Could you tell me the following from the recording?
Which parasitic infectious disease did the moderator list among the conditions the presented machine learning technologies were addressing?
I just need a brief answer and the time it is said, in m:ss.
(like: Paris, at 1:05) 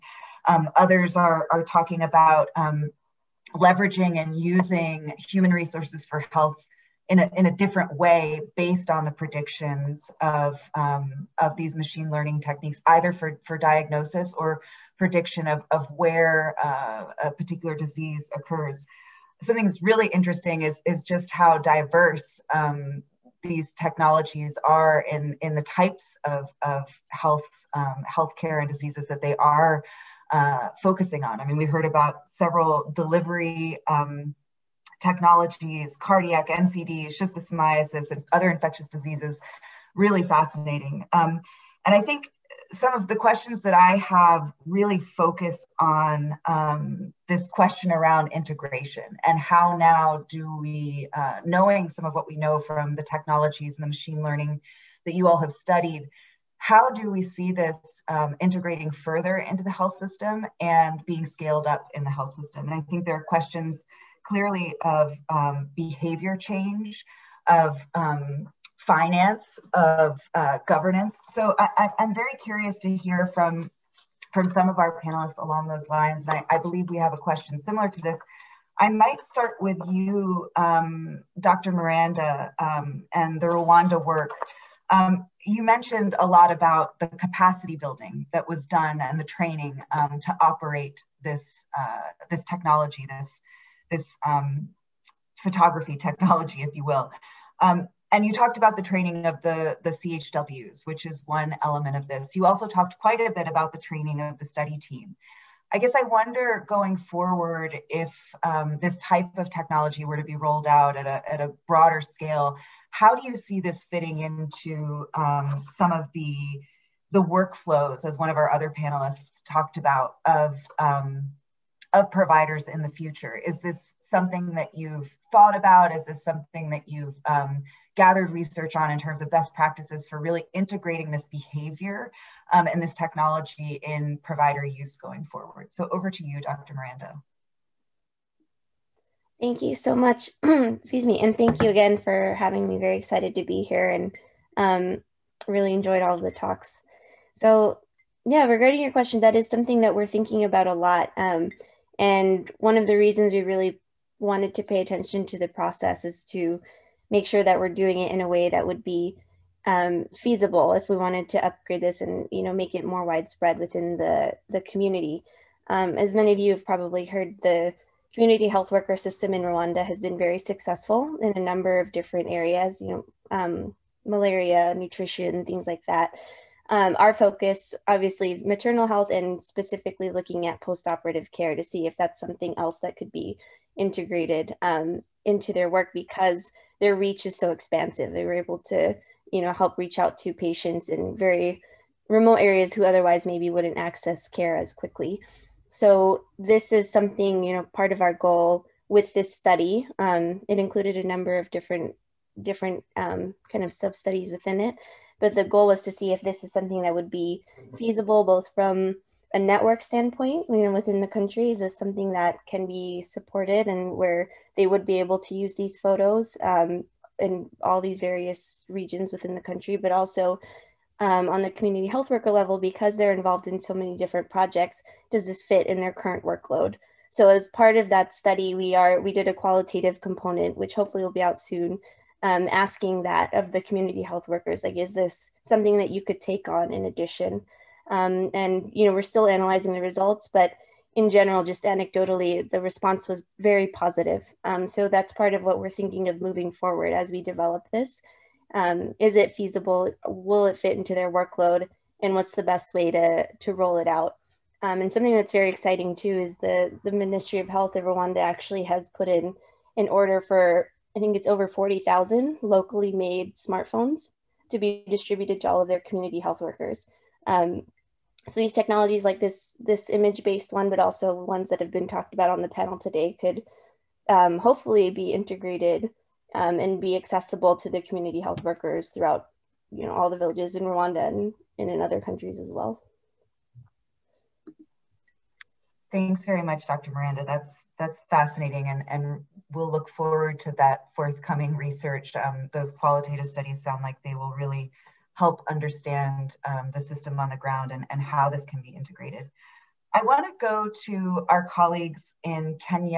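schistosomiasis, at 0:37.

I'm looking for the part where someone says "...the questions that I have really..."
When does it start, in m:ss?
0:43.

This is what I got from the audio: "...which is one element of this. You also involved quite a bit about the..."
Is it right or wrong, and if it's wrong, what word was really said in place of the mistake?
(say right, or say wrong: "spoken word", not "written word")
wrong: "talked", not "involved".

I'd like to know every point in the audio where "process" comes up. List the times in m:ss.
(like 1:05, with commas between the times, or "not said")
2:35.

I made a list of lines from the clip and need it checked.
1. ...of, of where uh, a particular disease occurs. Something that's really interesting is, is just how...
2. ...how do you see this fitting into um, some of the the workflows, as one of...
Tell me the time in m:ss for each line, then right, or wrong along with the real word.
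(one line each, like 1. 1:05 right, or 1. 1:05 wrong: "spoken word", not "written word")
1. 0:15 right
2. 1:52 right.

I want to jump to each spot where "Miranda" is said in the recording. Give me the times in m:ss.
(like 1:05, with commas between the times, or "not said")
1:21, 2:16, 4:46.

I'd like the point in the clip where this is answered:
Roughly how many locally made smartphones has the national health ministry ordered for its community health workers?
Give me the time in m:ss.
4:21.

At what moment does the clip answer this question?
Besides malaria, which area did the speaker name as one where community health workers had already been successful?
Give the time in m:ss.
2:54.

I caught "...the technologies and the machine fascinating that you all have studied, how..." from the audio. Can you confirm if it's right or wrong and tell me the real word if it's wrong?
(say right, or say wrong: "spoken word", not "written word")
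wrong: "learning", not "fascinating".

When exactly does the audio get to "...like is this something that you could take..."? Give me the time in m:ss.
3:54.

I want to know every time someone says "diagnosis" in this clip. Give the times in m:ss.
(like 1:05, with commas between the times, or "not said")
0:13.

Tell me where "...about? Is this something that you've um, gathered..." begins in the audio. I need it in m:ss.
2:05.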